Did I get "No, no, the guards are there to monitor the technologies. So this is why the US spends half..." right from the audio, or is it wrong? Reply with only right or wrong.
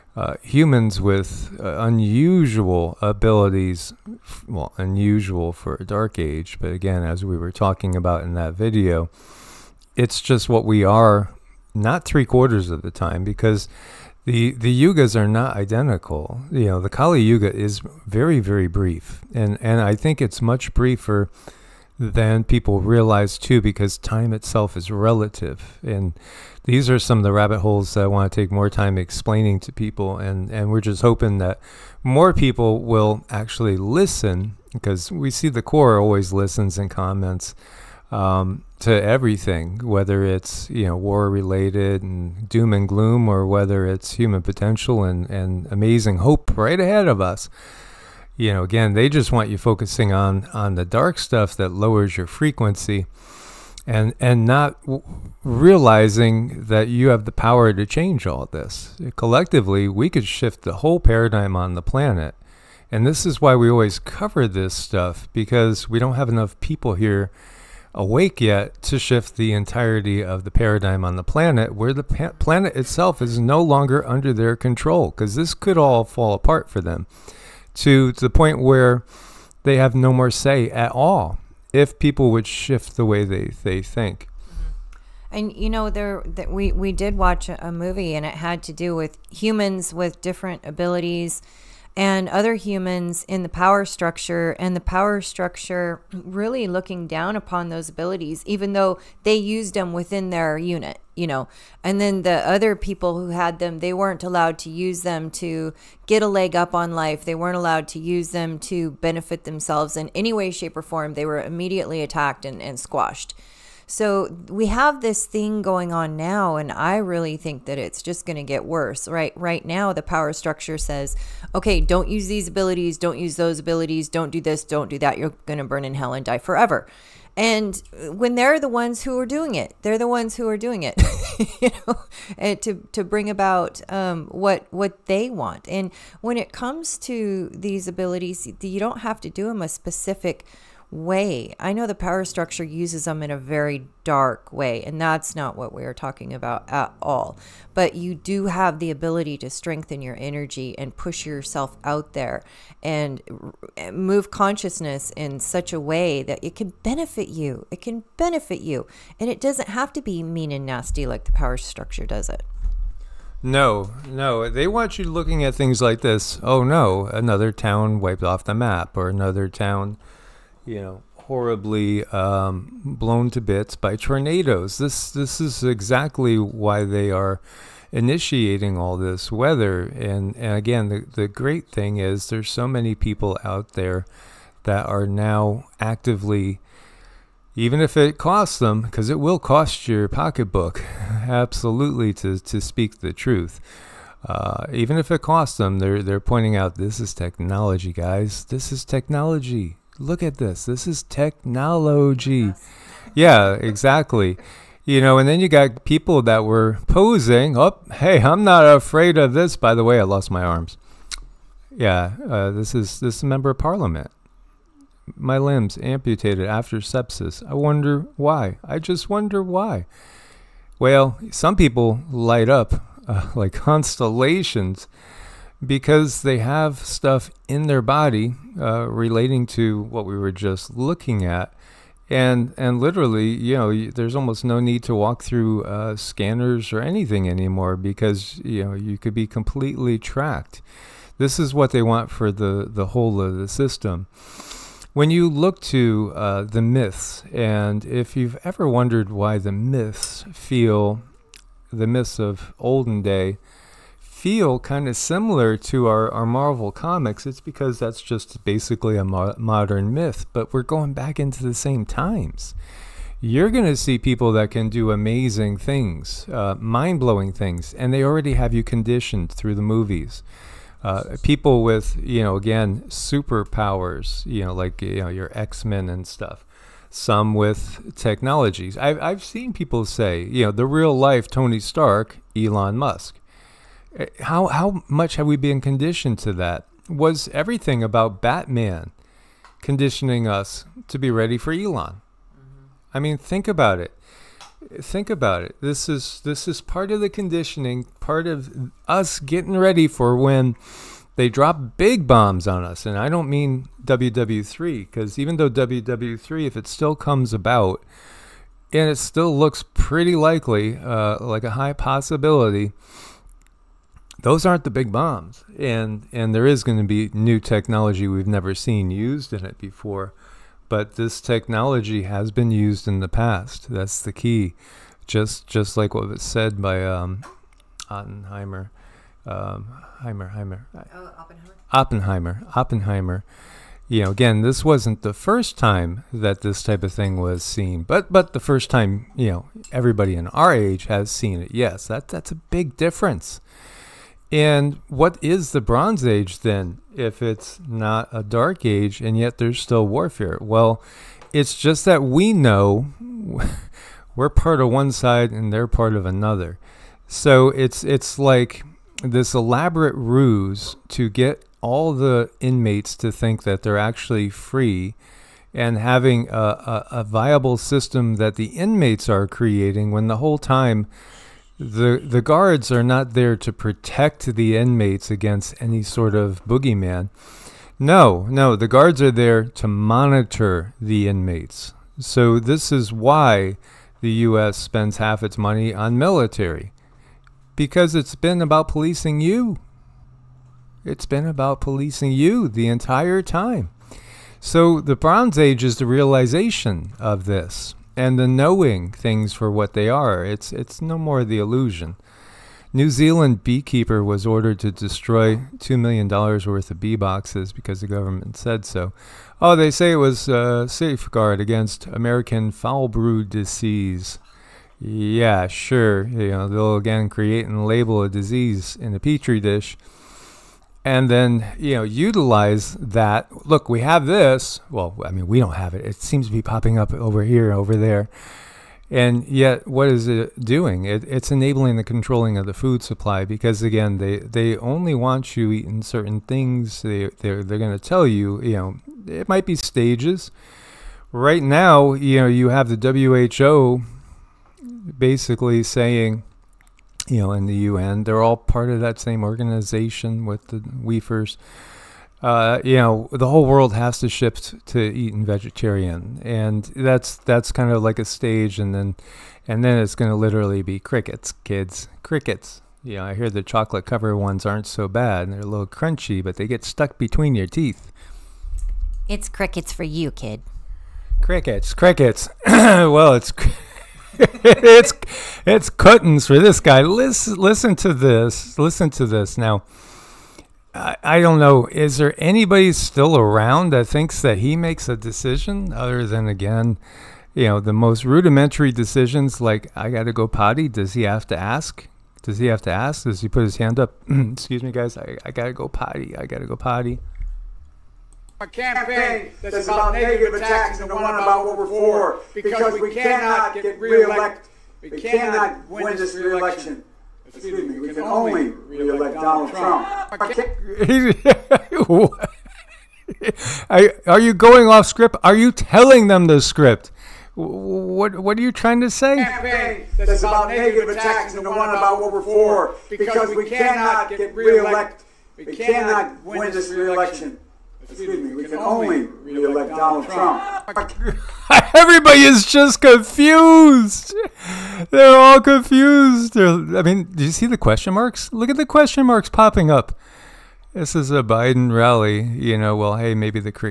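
wrong.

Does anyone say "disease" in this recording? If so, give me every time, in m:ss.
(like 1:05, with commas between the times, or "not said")
6:53, 6:58.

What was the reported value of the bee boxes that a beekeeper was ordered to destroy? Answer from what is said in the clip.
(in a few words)
$2 million.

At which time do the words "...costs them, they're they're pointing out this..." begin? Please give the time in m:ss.
3:15.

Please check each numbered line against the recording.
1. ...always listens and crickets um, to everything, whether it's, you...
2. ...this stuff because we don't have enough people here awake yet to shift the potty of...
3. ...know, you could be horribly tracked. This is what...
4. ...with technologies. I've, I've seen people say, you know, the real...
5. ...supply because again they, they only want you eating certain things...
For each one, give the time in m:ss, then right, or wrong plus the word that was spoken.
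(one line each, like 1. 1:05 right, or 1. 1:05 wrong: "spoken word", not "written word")
1. 0:35 wrong: "comments", not "crickets"
2. 1:04 wrong: "entirety", not "potty"
3. 3:58 wrong: "completely", not "horribly"
4. 4:37 right
5. 7:12 right.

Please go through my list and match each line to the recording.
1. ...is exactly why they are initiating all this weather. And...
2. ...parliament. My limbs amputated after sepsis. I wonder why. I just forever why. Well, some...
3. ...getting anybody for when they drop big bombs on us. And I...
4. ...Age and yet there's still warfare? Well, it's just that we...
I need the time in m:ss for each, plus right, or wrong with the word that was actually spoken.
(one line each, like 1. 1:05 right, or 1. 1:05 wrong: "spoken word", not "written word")
1. 2:55 right
2. 3:33 wrong: "wonder", not "forever"
3. 4:59 wrong: "ready", not "anybody"
4. 5:48 right.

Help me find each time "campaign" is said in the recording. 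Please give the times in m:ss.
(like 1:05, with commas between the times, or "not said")
8:18, 8:39.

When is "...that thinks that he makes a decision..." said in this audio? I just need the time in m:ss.
8:03.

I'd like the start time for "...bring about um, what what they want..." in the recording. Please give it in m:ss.
2:13.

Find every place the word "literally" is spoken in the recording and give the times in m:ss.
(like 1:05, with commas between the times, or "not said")
3:52, 7:40.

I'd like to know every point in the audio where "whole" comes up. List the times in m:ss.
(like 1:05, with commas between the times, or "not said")
1:00, 4:02, 6:10, 7:33.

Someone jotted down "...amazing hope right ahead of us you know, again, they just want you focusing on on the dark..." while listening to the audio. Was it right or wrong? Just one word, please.
right.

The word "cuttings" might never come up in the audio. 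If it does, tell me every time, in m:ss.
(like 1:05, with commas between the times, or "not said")
7:55.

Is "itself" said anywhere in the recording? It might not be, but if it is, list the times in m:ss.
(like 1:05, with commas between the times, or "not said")
0:24, 1:12.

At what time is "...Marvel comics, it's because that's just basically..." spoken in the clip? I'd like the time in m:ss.
4:16.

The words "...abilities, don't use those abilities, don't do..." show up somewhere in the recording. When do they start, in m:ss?
2:02.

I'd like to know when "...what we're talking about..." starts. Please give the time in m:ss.
2:25.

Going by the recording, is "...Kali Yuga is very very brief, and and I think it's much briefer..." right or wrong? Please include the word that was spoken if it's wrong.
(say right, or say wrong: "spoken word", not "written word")
right.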